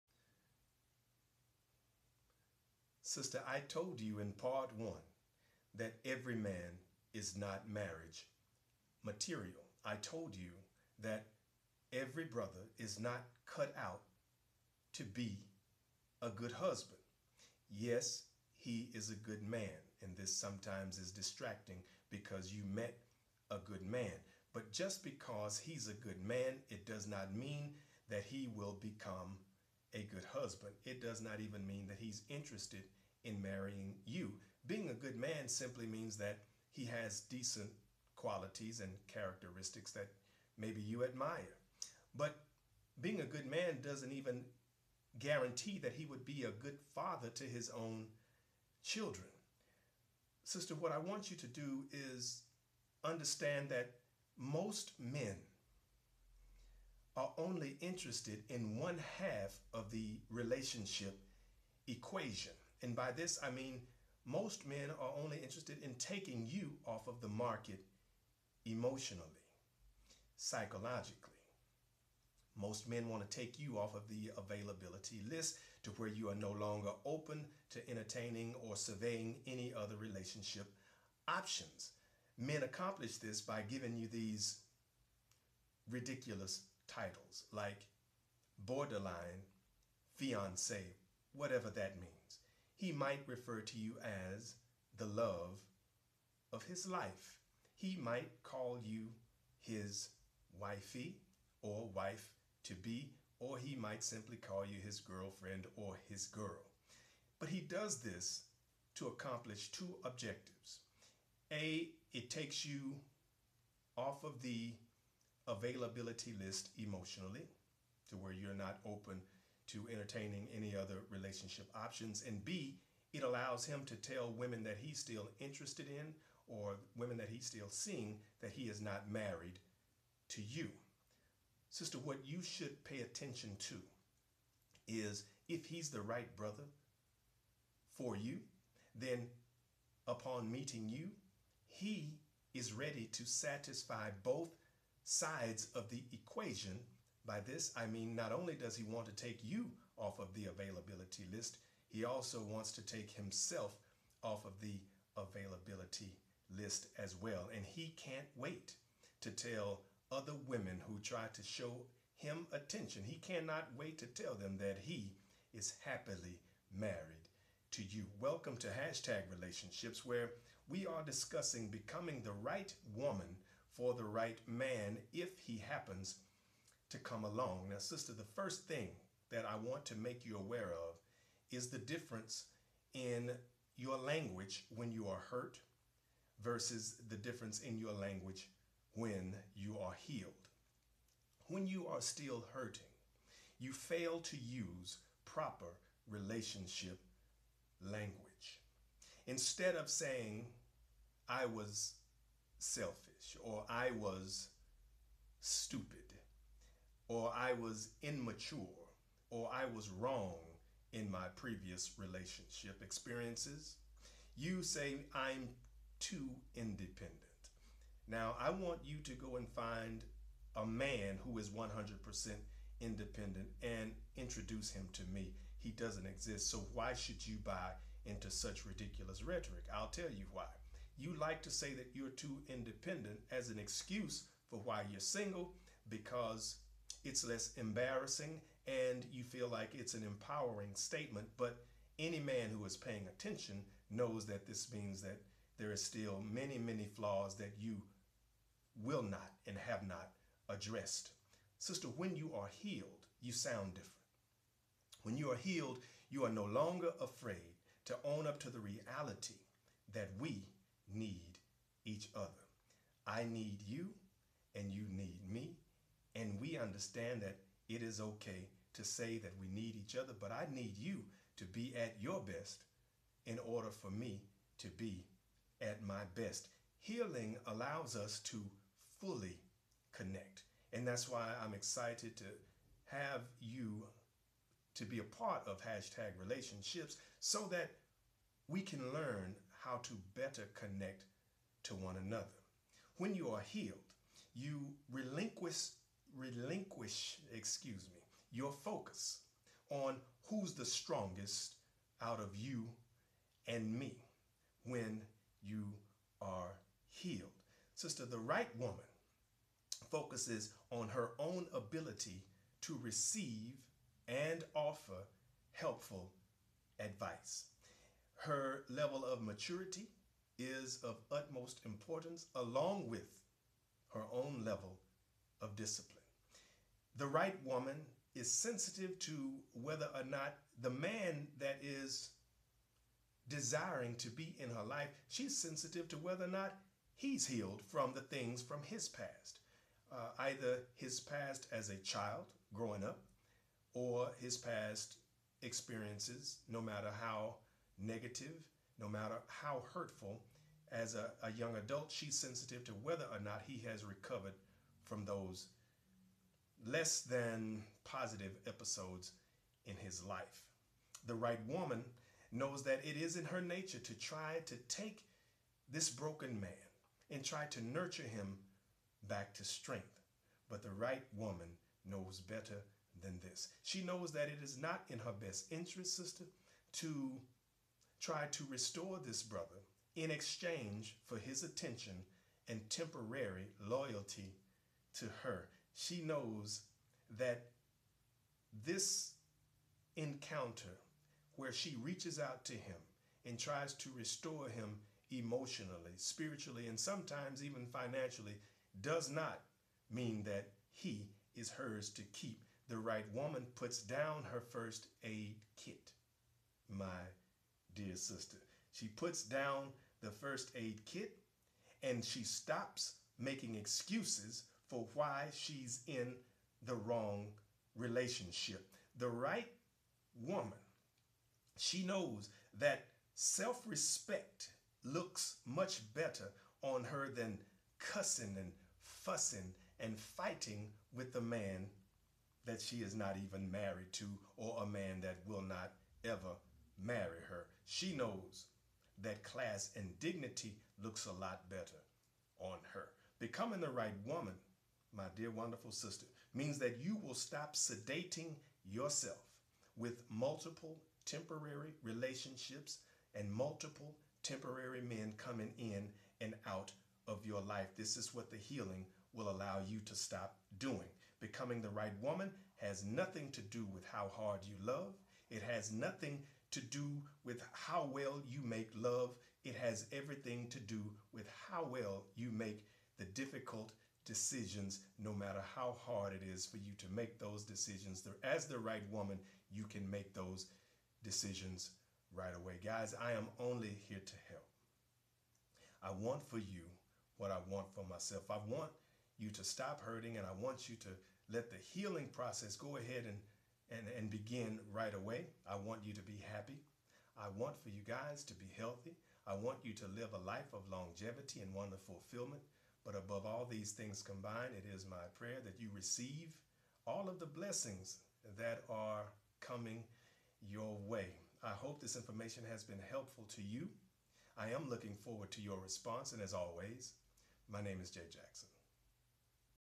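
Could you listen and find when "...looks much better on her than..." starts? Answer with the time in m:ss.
7:04.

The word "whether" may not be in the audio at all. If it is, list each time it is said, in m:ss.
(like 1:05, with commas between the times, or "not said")
5:29, 5:35, 5:52.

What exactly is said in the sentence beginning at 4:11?
Sister, when you are healed, you sound different.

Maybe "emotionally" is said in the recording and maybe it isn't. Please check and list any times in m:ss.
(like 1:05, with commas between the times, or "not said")
1:08, 1:56, 6:35.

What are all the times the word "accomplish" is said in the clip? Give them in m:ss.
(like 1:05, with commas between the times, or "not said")
1:22, 1:49.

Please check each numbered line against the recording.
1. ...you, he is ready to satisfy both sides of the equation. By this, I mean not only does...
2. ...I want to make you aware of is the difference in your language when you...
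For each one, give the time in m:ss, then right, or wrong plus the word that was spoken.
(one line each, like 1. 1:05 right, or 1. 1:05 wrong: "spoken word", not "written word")
1. 2:20 right
2. 2:59 right.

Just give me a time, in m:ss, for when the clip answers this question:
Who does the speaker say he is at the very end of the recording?
8:37.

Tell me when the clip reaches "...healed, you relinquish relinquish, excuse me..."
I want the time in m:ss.
4:53.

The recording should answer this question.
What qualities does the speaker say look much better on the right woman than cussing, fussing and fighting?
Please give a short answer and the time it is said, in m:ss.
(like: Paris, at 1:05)
class and dignity, at 7:19.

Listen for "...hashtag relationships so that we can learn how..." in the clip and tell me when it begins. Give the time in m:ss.
4:45.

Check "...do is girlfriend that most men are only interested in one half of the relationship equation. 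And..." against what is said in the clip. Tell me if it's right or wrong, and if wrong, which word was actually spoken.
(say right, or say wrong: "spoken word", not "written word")
wrong: "understand", not "girlfriend".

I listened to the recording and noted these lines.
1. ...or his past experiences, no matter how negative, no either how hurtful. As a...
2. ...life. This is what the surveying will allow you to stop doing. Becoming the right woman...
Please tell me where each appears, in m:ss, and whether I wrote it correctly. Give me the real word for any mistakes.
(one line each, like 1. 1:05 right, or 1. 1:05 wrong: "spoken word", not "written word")
1. 5:43 wrong: "matter", not "either"
2. 7:37 wrong: "healing", not "surveying".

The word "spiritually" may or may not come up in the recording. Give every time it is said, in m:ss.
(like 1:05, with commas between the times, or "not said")
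6:35.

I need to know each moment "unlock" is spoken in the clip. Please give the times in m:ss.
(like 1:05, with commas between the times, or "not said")
not said.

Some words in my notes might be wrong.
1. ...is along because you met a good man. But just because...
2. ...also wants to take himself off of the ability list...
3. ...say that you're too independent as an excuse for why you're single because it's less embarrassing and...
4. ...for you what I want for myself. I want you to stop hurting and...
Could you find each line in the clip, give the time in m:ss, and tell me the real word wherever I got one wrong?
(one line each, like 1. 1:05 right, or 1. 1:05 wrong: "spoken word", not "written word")
1. 0:20 wrong: "distracting", not "along"
2. 2:32 wrong: "availability", not "ability"
3. 3:51 right
4. 8:06 right.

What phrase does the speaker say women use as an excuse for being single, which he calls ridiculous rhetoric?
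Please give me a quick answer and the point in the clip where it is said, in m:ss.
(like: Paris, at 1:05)
I'm too independent, at 3:35.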